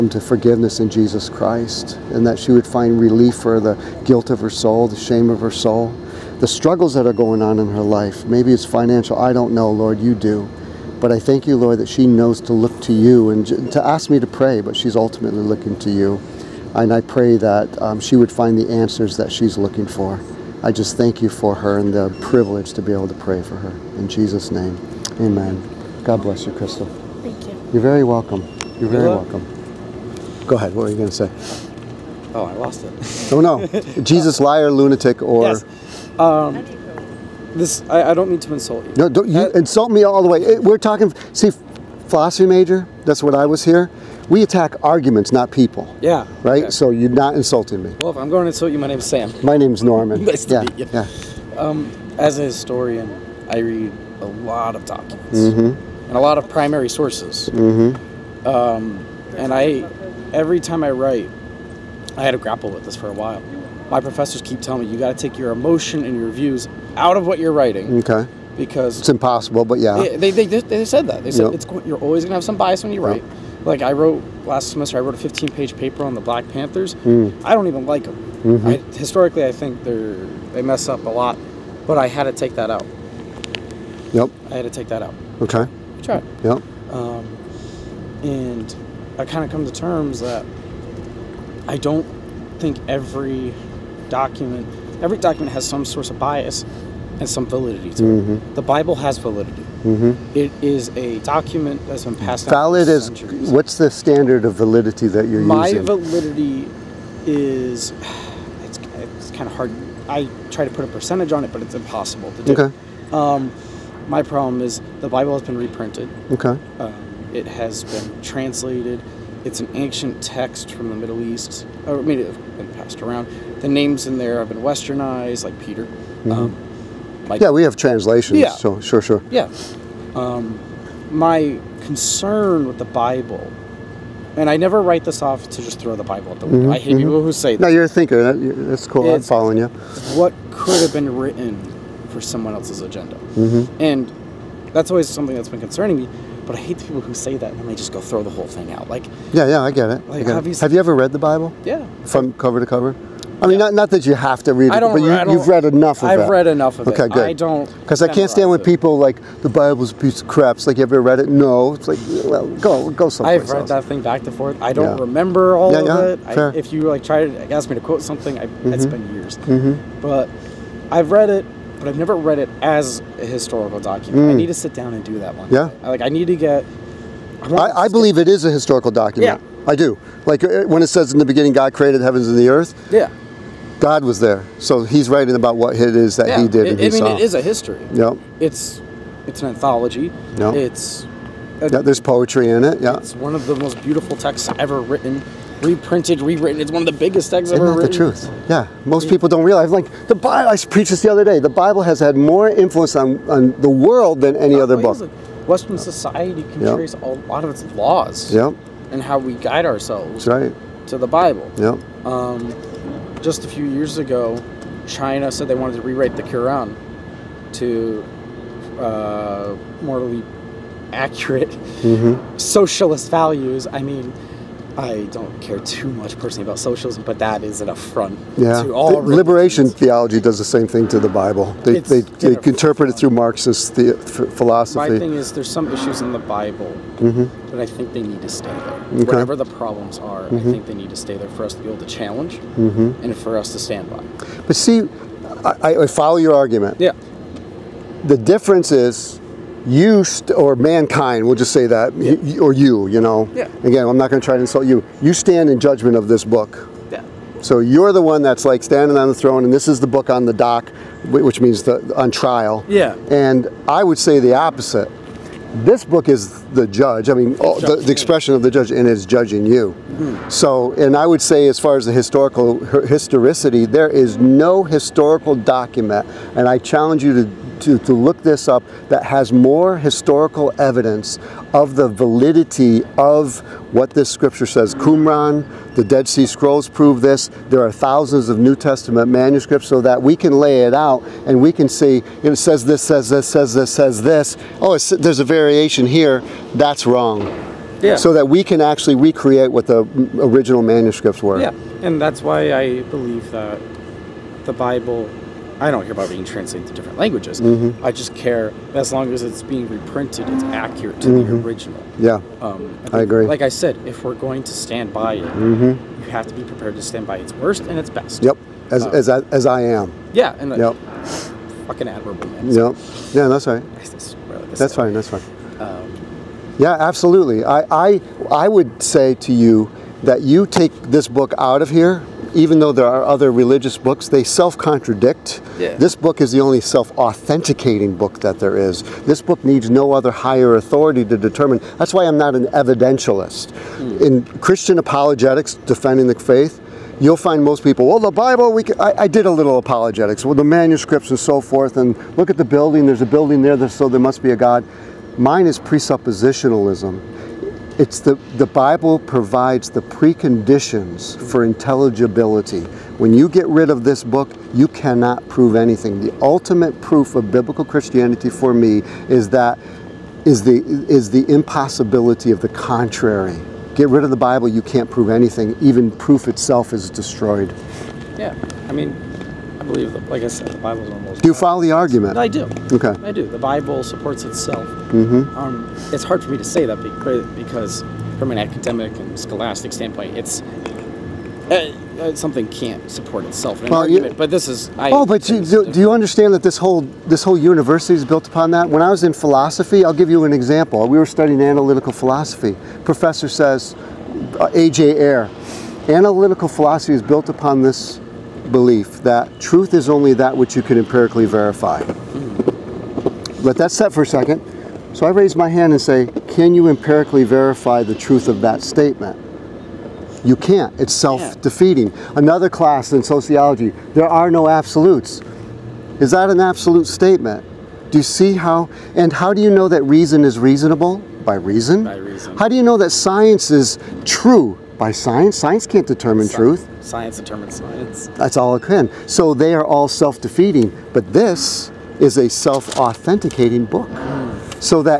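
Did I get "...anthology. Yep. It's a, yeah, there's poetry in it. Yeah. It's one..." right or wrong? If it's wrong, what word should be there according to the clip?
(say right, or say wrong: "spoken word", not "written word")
right.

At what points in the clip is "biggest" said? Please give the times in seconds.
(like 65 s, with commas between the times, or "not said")
196 s.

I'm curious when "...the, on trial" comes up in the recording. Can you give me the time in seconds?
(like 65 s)
261 s.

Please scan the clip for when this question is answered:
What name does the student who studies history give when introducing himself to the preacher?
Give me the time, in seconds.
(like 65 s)
49 s.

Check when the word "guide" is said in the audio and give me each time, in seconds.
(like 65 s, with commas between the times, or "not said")
209 s.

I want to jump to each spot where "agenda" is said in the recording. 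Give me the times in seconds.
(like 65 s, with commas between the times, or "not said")
142 s.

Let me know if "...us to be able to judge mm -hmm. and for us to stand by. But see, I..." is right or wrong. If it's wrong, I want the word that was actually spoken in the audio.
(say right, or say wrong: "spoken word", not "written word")
wrong: "challenge", not "judge".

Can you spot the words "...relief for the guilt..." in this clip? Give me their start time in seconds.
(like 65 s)
3 s.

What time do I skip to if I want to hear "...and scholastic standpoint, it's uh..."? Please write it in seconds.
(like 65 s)
388 s.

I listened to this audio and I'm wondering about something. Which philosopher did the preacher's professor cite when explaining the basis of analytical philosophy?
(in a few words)
A.J. Ayer.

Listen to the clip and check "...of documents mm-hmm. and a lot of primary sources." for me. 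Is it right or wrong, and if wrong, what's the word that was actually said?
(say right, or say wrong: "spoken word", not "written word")
right.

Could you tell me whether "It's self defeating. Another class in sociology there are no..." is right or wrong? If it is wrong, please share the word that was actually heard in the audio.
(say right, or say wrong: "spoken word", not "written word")
right.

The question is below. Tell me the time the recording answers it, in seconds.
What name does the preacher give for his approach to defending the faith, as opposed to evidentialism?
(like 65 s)
355 s.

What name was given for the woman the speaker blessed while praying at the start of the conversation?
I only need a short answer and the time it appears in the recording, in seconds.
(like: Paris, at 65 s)
Crystal, at 26 s.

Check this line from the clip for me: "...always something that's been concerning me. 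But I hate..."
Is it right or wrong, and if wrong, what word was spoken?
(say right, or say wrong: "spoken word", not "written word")
right.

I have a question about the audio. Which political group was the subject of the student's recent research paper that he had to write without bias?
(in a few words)
Black Panthers.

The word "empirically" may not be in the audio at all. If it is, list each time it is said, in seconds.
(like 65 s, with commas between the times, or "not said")
410 s, 416 s.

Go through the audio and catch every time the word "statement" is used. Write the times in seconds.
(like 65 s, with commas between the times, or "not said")
418 s, 426 s.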